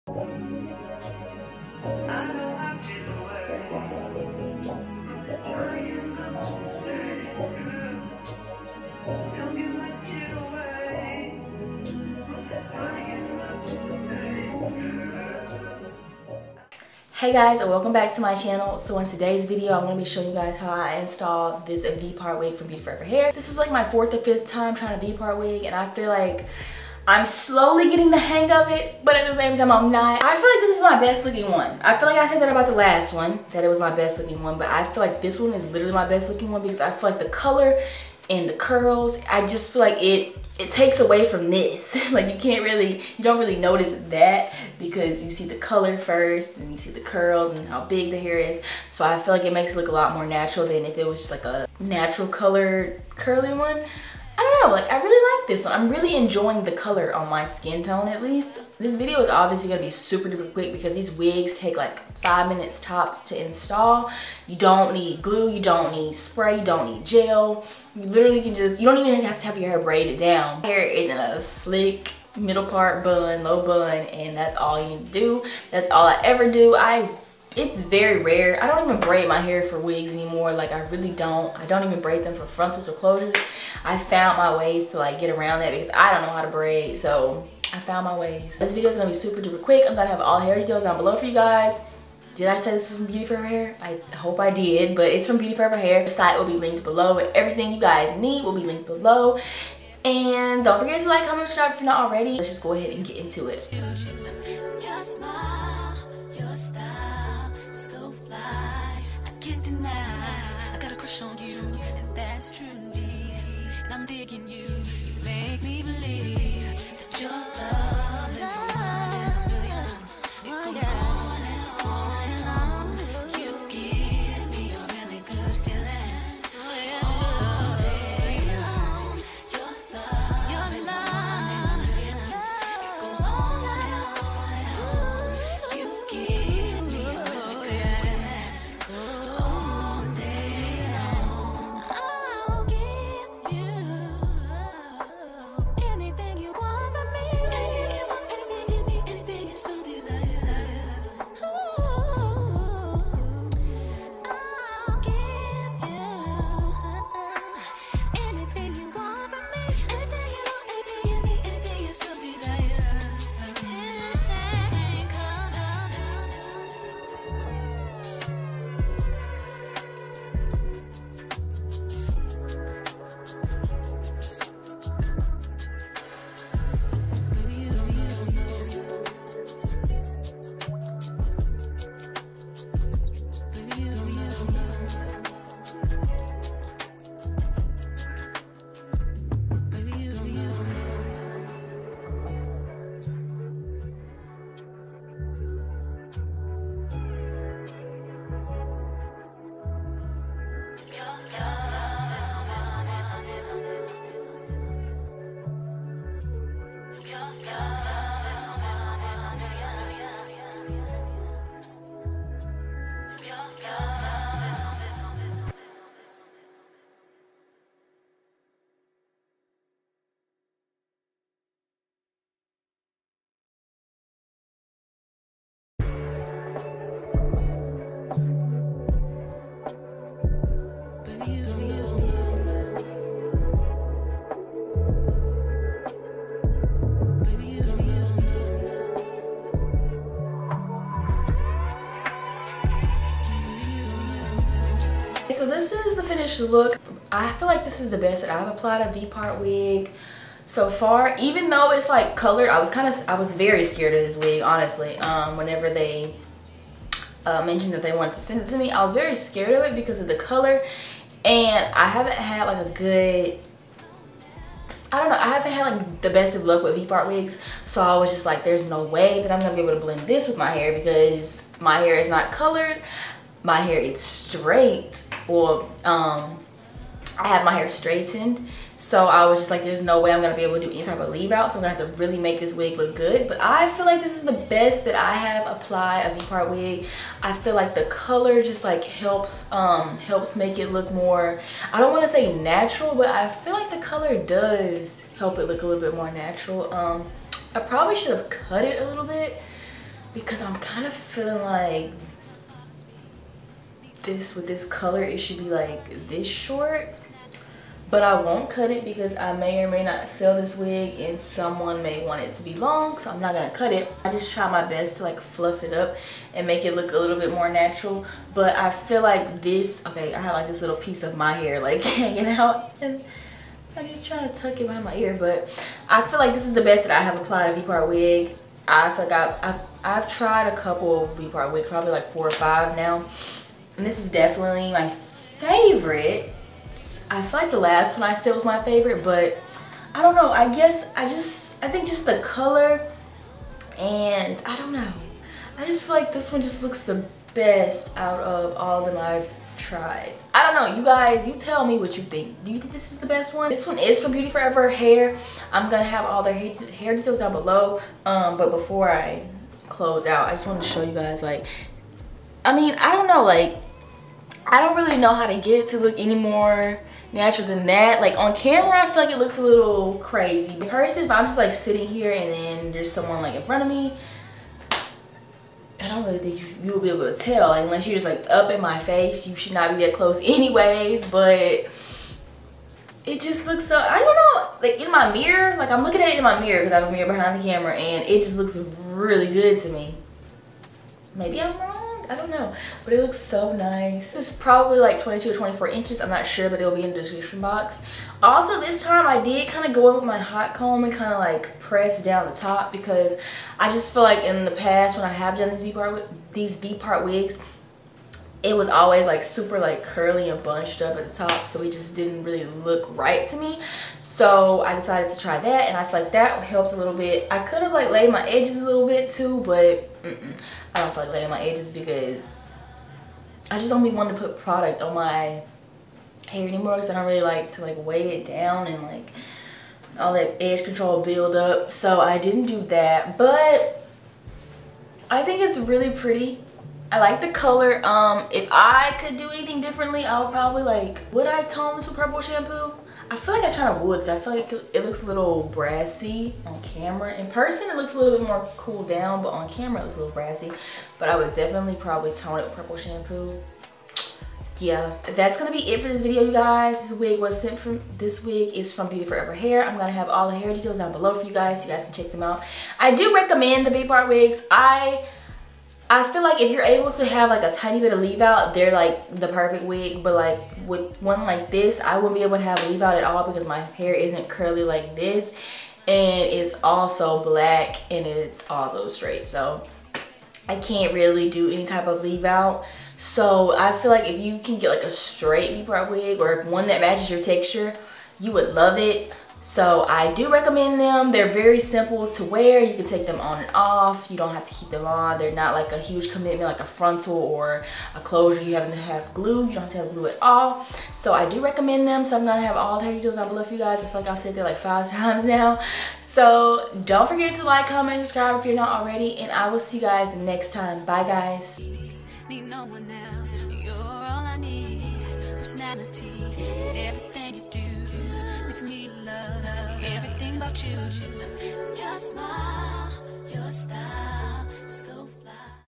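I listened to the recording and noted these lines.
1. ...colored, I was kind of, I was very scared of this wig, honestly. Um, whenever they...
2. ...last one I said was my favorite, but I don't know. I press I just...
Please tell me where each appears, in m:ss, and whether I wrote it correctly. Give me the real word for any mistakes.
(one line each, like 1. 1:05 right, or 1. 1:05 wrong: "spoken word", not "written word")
1. 4:12 right
2. 5:37 wrong: "guess", not "press".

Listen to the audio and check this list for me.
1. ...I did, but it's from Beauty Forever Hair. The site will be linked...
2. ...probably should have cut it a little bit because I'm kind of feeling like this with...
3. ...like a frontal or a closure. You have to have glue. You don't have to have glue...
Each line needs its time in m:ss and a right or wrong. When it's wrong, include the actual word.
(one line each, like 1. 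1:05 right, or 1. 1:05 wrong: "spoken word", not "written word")
1. 1:34 right
2. 4:57 right
3. 8:16 right.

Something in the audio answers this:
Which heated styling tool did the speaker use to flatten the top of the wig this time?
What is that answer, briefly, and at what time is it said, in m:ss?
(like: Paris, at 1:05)
hot comb, at 6:40.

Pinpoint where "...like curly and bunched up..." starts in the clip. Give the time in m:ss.
6:49.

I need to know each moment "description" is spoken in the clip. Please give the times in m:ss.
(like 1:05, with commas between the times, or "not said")
6:36.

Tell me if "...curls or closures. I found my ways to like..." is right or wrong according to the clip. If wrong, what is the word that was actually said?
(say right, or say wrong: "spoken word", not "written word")
wrong: "frontals", not "curls".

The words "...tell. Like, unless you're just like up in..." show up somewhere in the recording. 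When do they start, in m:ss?
6:17.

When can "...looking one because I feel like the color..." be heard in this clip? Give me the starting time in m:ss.
0:36.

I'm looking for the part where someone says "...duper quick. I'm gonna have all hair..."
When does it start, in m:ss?
1:29.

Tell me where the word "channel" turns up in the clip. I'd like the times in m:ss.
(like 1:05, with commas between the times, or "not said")
0:18.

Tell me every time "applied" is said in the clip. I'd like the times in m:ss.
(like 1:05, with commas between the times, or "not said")
4:08, 4:45, 5:27.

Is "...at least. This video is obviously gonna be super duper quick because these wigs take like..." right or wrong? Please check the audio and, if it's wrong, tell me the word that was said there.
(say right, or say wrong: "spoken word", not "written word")
right.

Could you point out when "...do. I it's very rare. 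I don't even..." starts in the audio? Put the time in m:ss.
1:16.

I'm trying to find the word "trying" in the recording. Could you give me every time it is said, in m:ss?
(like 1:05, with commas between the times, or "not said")
0:24, 5:24.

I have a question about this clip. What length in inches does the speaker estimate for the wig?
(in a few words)
22 or 24 inches.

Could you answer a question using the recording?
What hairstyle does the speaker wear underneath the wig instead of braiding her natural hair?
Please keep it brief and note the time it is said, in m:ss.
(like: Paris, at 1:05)
slick middle part bun, at 1:11.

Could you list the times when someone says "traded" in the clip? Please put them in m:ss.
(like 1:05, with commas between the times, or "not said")
not said.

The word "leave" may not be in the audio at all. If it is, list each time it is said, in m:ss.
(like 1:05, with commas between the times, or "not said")
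4:41, 7:47, 7:52, 8:02.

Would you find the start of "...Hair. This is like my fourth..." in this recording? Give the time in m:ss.
0:23.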